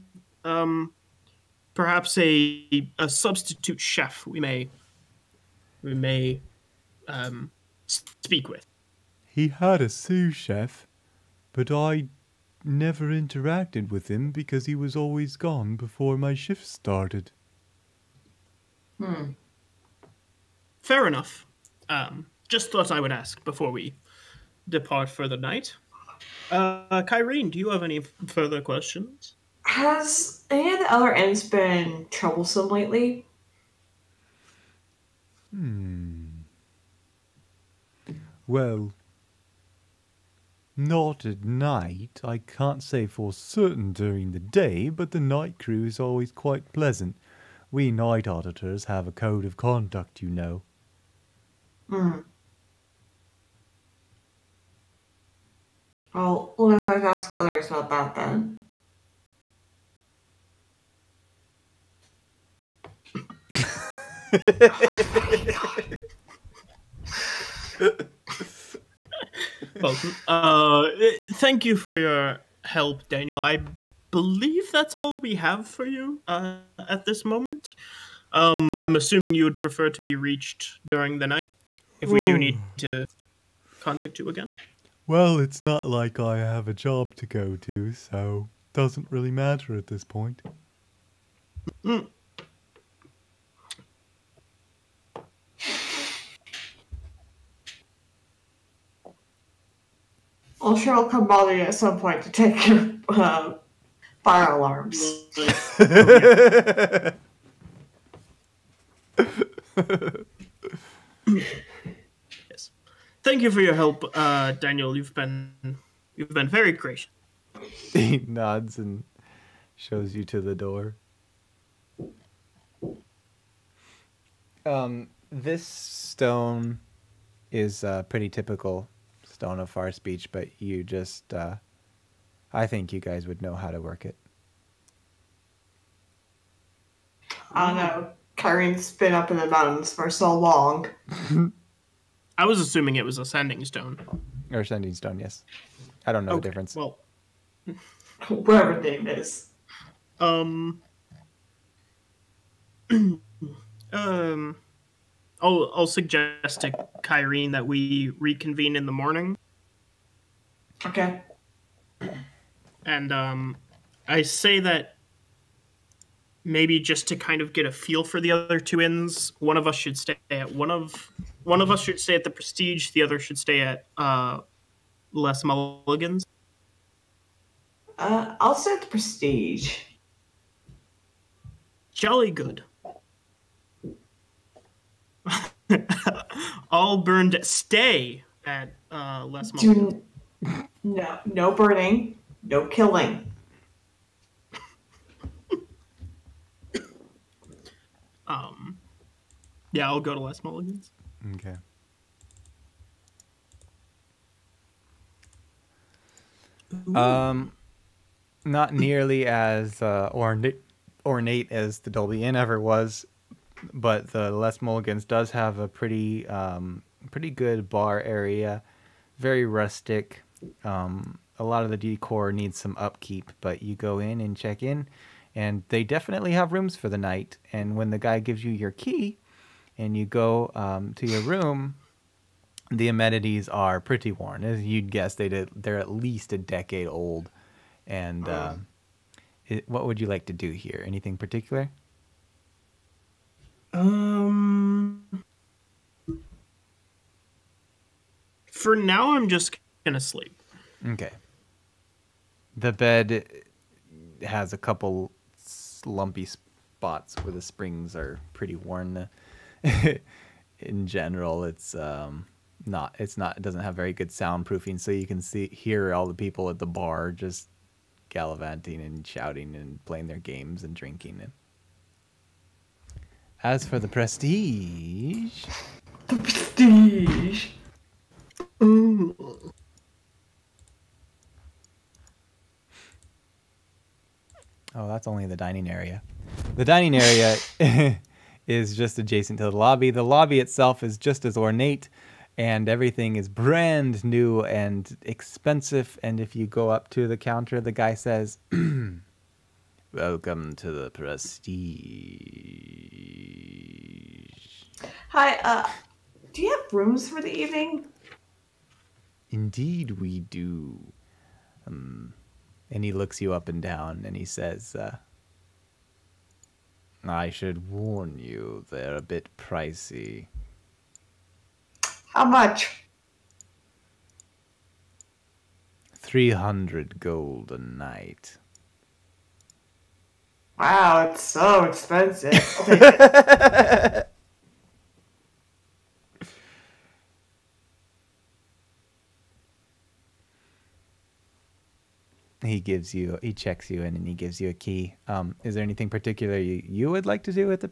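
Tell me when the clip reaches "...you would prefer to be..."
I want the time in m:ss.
1:19.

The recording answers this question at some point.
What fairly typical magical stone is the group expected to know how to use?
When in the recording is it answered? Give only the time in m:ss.
2:09.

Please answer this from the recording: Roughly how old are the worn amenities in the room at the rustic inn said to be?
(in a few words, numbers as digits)
A decade.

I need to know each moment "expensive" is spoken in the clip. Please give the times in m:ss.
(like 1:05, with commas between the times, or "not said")
4:55, 5:31.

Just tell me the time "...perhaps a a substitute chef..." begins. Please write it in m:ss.
0:01.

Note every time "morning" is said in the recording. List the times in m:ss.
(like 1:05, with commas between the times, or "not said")
2:38.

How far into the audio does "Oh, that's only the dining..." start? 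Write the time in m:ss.
4:44.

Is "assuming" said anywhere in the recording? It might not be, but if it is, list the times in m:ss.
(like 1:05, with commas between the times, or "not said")
1:18, 2:22.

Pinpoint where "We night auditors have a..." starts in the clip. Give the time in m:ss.
0:47.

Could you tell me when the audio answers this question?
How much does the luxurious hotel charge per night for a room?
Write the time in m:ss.
5:25.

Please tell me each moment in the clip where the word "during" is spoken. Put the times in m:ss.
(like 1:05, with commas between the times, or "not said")
0:43, 1:20.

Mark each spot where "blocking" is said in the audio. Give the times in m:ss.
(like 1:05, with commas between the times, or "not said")
not said.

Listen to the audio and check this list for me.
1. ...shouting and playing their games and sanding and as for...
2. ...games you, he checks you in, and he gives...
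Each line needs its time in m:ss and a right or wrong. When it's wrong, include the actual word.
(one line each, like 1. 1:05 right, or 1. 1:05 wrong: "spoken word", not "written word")
1. 4:29 wrong: "drinking", not "sanding"
2. 5:42 wrong: "gives", not "games".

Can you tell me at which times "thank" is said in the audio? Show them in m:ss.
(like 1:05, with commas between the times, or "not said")
1:11, 1:53.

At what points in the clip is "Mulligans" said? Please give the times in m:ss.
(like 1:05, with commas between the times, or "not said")
2:55, 3:20, 3:34.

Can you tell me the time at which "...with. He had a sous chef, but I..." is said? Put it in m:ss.
0:08.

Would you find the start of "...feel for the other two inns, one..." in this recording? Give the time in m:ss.
2:47.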